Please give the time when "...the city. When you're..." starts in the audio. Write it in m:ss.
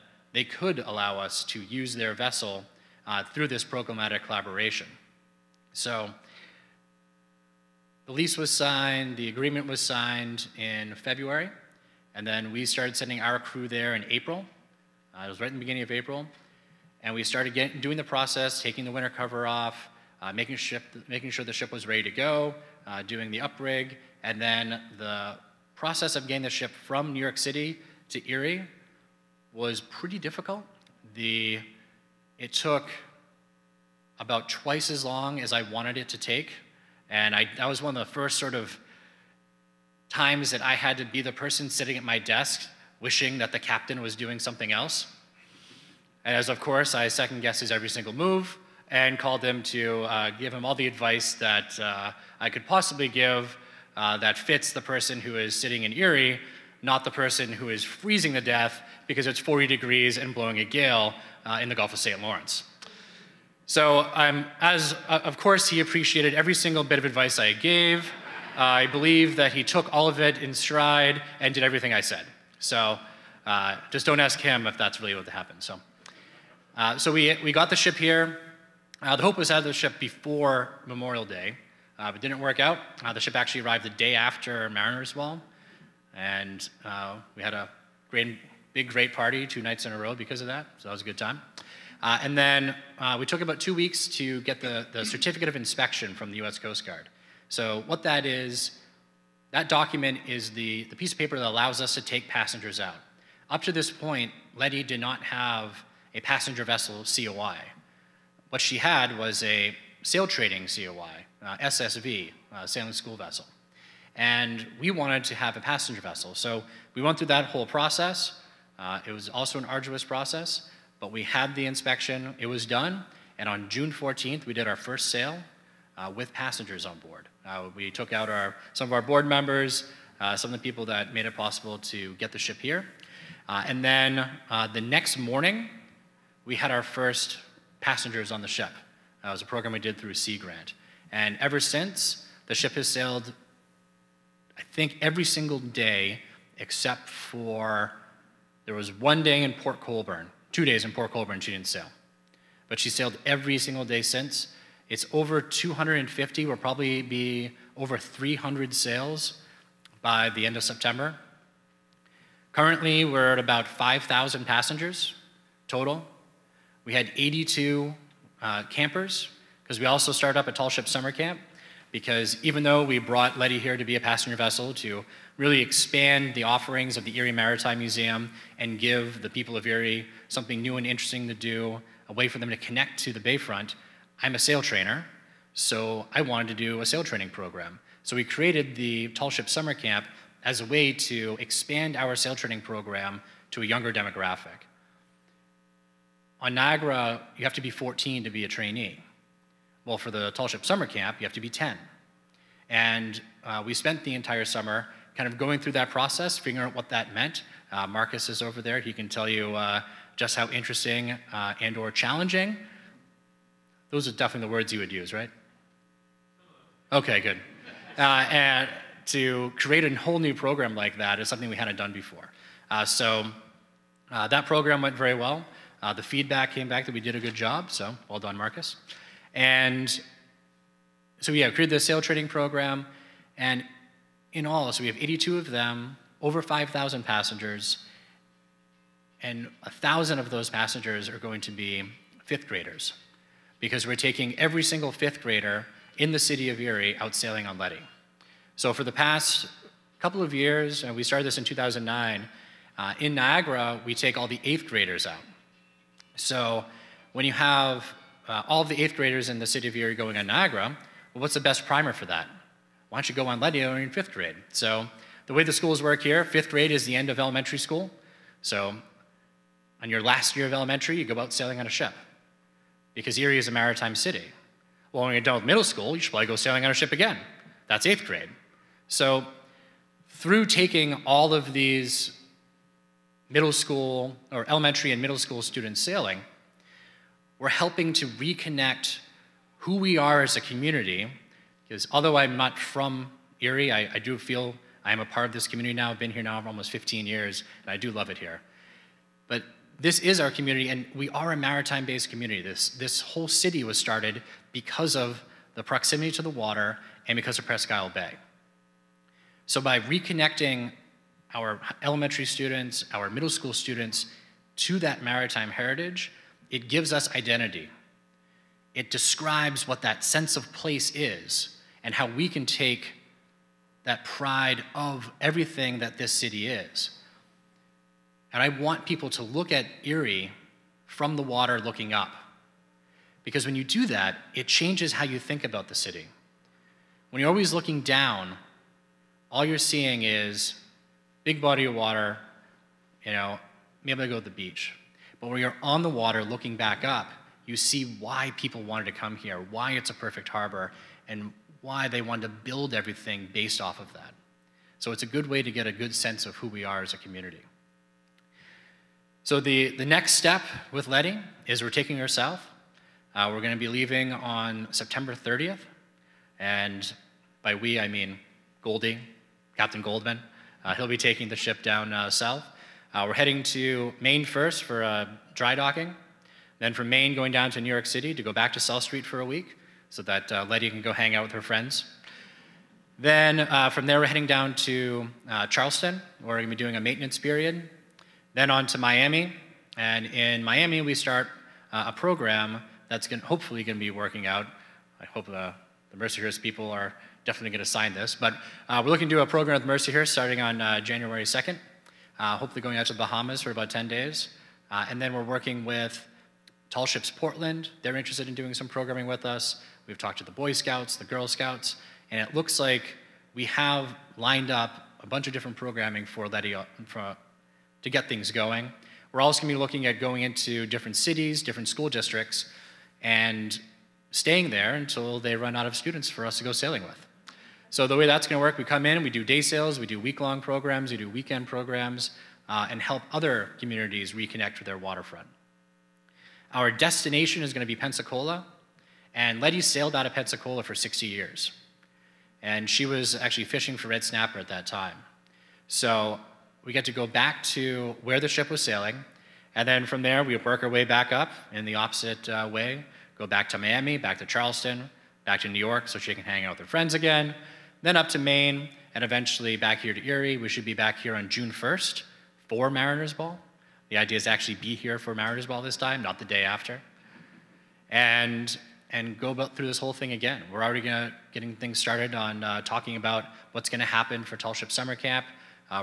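5:35.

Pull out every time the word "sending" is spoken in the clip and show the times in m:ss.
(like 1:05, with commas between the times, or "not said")
0:12.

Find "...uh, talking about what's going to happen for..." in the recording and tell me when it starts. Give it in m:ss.
7:52.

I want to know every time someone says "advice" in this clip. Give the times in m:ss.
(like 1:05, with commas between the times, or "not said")
0:50, 1:07.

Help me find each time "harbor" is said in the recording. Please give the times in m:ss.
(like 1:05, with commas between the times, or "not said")
5:50.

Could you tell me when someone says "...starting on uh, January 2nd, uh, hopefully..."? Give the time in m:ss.
6:40.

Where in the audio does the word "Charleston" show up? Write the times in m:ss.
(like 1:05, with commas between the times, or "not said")
6:25, 7:34.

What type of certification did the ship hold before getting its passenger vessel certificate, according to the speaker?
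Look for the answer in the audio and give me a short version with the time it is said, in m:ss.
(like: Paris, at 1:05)
Sailing school vessel, at 1:52.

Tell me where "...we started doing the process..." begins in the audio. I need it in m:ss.
0:17.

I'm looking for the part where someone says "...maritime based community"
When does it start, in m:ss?
5:01.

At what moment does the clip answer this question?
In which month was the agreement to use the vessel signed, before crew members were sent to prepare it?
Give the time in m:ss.
0:10.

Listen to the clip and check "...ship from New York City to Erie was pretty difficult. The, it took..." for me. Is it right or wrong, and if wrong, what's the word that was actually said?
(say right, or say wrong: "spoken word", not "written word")
right.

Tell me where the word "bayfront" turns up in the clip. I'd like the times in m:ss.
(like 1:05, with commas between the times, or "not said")
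3:03.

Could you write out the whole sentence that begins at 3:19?
Well, for the Tall Ship Summer Camp, you have to be 10.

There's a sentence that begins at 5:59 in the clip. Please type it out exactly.
So the, the next step with Lettie is we're taking her south.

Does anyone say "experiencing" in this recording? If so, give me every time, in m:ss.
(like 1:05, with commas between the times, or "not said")
not said.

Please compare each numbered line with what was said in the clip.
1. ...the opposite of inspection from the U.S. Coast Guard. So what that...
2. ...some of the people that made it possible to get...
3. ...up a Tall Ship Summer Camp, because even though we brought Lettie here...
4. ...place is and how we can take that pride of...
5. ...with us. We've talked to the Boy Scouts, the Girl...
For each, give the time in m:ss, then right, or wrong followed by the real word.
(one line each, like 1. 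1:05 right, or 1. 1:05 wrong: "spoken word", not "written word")
1. 1:34 wrong: "certificate", not "opposite"
2. 2:10 right
3. 2:50 right
4. 5:20 right
5. 6:49 right.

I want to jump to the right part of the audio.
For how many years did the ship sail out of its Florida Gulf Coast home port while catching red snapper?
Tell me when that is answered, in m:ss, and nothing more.
7:20.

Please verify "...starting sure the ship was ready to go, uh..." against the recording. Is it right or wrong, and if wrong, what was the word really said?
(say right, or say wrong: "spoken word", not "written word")
wrong: "making", not "starting".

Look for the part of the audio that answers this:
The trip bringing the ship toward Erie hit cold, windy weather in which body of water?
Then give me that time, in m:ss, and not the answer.
1:01.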